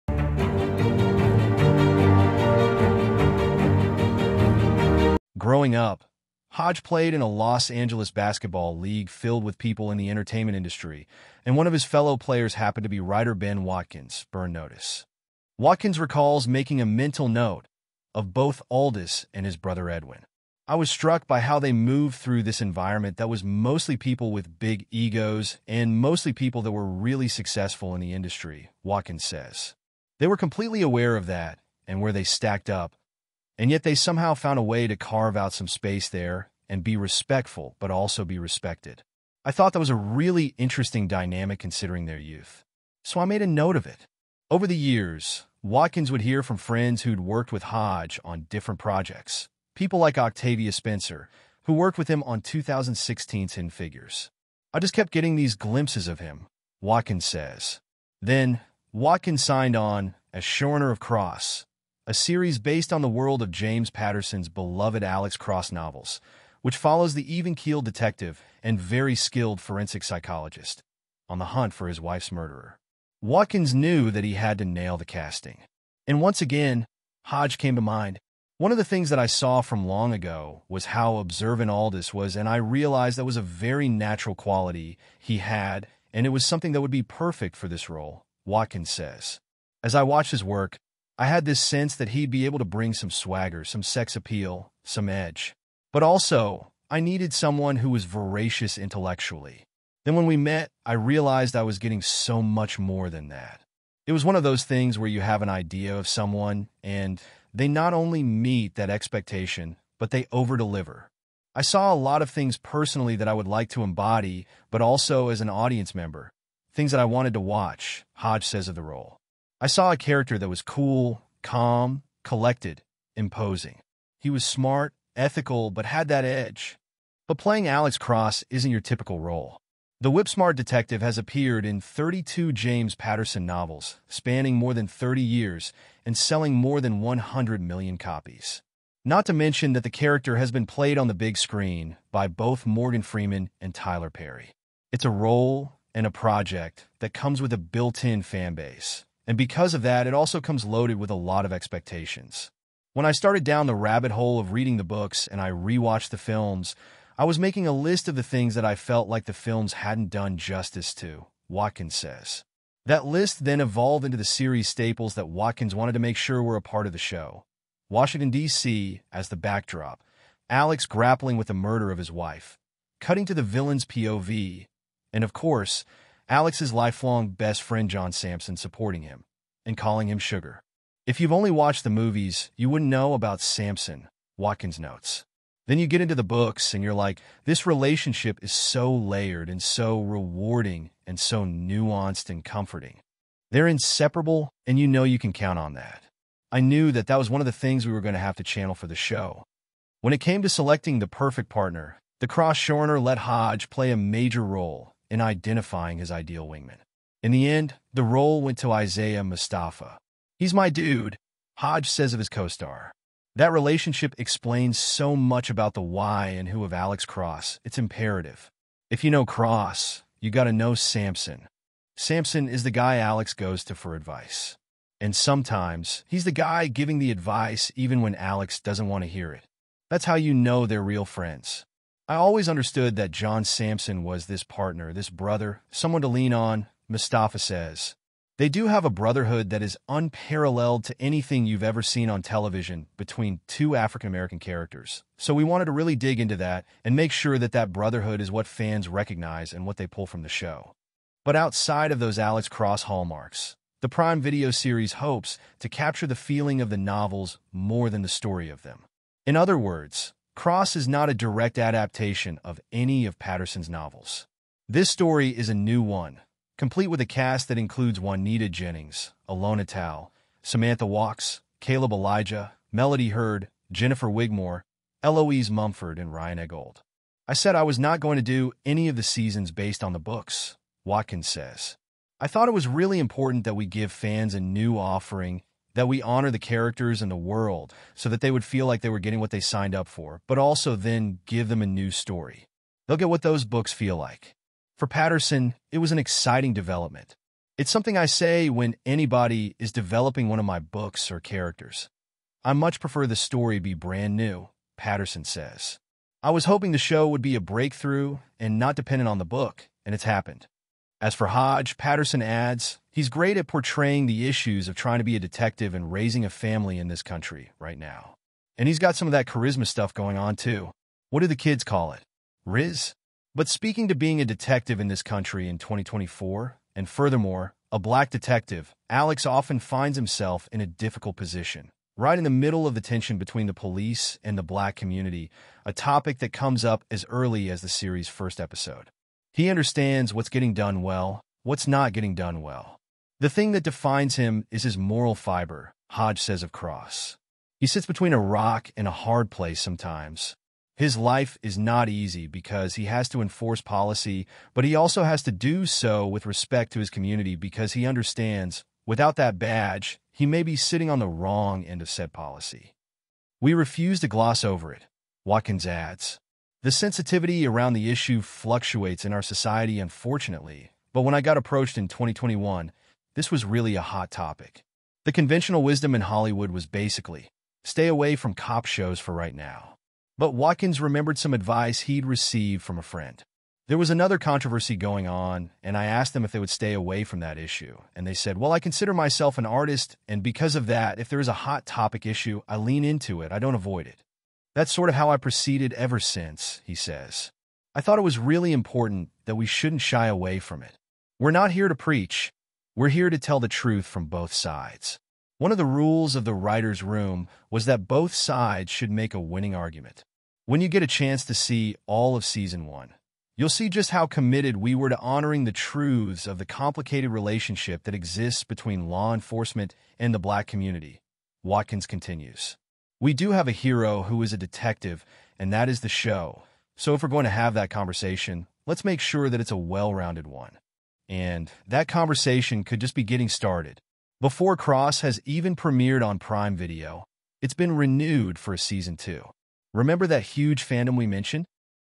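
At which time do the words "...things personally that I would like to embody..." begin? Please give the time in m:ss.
1:52.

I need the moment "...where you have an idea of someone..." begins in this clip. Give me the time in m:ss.
1:44.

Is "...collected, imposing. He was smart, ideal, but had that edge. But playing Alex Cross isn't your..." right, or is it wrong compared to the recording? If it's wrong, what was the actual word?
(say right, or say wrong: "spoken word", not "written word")
wrong: "ethical", not "ideal".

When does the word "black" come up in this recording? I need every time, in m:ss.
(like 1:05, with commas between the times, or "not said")
5:27, 5:34, 7:00.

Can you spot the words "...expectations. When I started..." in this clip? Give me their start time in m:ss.
2:31.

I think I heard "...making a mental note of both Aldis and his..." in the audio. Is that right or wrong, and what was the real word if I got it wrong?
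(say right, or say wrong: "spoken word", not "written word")
right.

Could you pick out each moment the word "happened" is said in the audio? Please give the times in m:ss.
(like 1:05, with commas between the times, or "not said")
0:12, 5:10.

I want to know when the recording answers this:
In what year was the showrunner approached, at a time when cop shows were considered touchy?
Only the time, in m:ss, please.
6:11.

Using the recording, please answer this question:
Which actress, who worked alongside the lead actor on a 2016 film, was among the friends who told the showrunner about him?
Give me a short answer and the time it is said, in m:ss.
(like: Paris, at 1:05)
Octavia Spencer, at 0:50.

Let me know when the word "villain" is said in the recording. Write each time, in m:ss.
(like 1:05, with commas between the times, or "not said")
2:53.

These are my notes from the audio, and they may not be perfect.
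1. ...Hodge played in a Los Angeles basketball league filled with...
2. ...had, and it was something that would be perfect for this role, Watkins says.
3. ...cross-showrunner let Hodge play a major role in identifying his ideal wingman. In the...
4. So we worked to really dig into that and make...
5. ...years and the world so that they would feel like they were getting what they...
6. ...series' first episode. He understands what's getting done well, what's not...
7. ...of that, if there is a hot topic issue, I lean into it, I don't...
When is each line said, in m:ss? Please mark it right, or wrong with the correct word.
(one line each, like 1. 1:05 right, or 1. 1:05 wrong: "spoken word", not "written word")
1. 0:06 right
2. 1:25 right
3. 3:22 right
4. 4:05 wrong: "wanted", not "worked"
5. 4:46 wrong: "characters", not "years"
6. 5:37 right
7. 6:30 right.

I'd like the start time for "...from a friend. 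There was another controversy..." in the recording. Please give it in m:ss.
6:22.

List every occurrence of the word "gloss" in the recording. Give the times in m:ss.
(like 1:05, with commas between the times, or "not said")
6:04.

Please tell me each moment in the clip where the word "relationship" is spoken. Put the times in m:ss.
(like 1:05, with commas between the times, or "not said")
3:07, 3:33, 6:57.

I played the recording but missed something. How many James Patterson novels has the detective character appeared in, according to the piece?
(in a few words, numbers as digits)
32.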